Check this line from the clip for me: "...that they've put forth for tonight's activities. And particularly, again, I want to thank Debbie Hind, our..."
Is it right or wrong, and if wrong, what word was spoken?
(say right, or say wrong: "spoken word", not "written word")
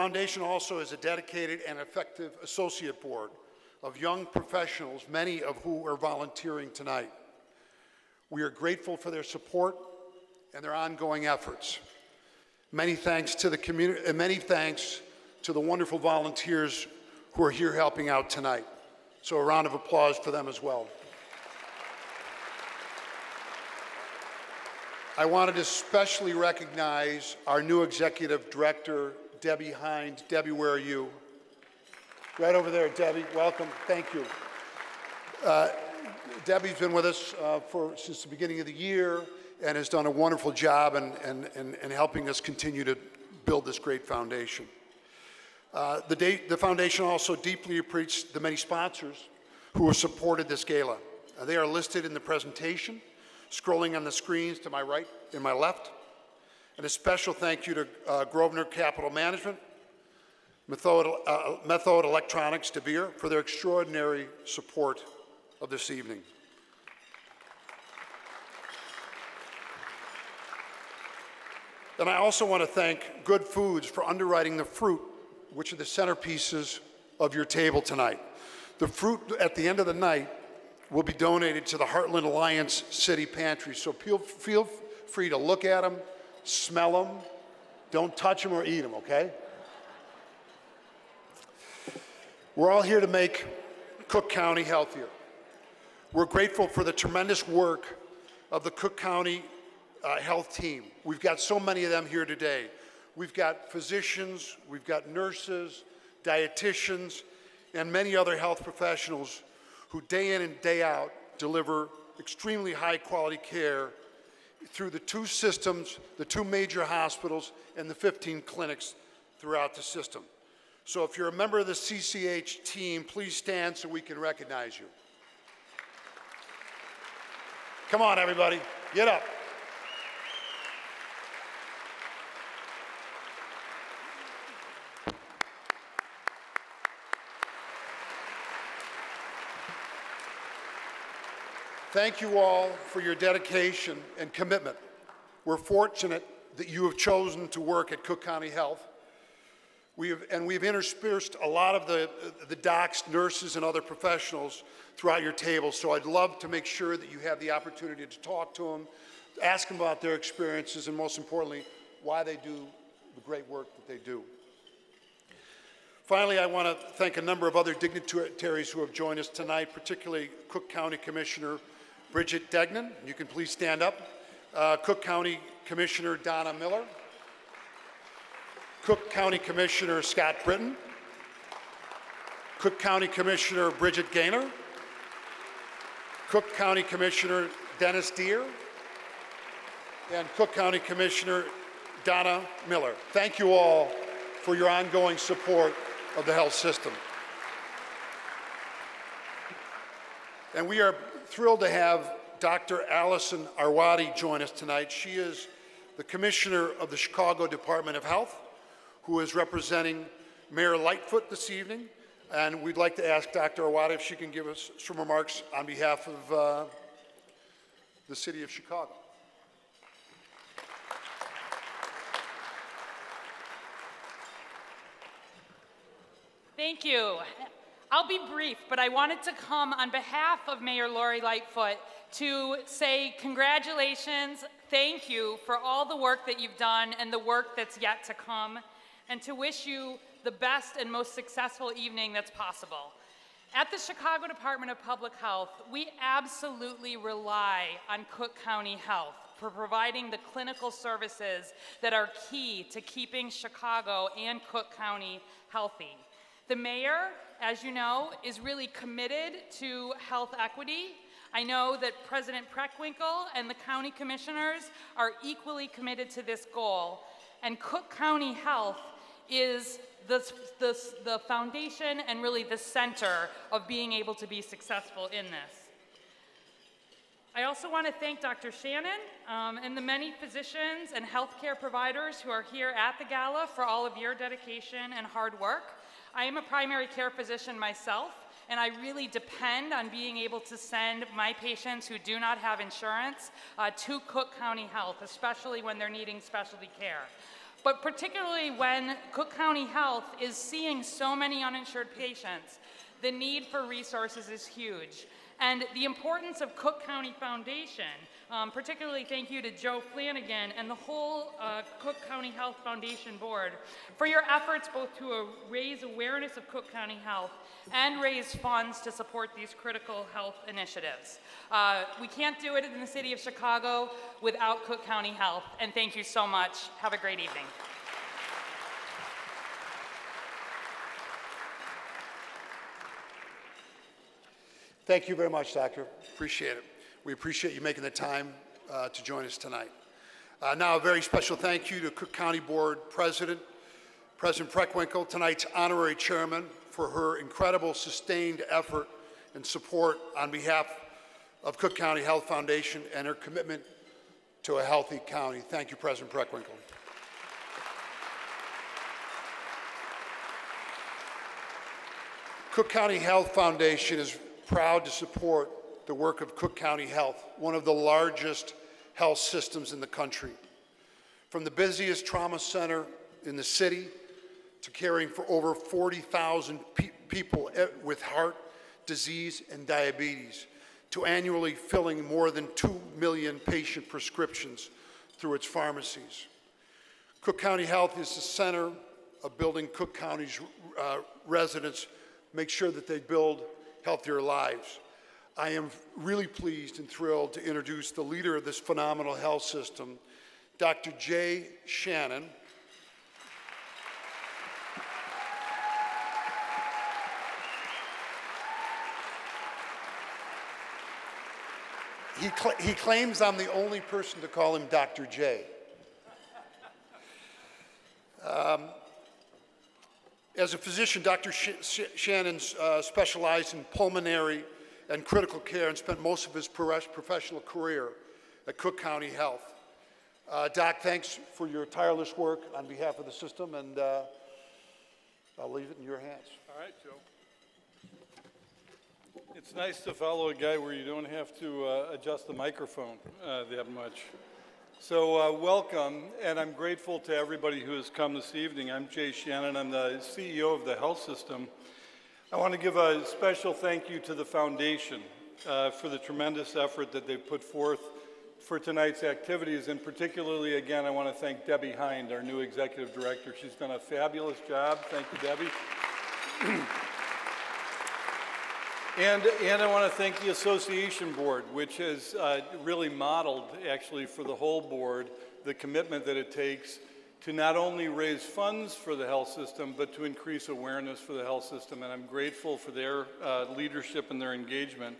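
right.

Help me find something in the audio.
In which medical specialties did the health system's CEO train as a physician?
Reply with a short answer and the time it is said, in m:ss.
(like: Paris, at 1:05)
pulmonary and critical care, at 7:03.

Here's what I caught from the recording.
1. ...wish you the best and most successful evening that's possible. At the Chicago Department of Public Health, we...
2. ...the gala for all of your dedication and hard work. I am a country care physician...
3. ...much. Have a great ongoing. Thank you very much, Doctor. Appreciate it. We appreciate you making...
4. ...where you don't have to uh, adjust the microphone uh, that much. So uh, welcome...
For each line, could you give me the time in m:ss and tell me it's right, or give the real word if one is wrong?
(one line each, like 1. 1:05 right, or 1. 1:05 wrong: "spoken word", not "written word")
1. 3:59 right
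2. 4:42 wrong: "primary", not "country"
3. 5:26 wrong: "evening", not "ongoing"
4. 7:20 right.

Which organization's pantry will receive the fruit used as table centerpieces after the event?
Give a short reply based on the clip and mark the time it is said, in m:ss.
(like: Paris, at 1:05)
Heartland Alliance City Pantry, at 1:21.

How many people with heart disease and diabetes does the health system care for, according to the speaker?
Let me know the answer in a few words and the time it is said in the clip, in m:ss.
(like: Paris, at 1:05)
40,000, at 6:15.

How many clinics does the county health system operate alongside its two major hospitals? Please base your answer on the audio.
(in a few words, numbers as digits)
15.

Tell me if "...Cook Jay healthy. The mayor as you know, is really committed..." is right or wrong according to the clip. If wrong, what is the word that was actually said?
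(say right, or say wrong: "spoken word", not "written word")
wrong: "County", not "Jay".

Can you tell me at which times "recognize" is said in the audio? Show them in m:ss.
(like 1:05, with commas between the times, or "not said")
0:26, 2:04.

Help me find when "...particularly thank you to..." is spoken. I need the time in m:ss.
5:08.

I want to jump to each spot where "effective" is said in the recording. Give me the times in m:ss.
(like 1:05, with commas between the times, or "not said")
0:01.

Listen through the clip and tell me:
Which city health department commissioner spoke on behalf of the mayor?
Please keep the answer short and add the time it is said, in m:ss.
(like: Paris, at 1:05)
Dr. Allison Arwady, at 3:22.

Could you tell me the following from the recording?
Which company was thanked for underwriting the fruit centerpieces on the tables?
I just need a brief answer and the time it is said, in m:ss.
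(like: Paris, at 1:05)
Good Foods, at 1:13.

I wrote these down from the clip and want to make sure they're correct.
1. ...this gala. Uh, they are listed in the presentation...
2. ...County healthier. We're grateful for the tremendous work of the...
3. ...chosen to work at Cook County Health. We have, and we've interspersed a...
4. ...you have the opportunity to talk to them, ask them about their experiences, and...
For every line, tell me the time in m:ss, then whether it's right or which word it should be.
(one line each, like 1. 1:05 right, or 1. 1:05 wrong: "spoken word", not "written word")
1. 0:50 right
2. 1:34 right
3. 2:26 right
4. 2:37 right.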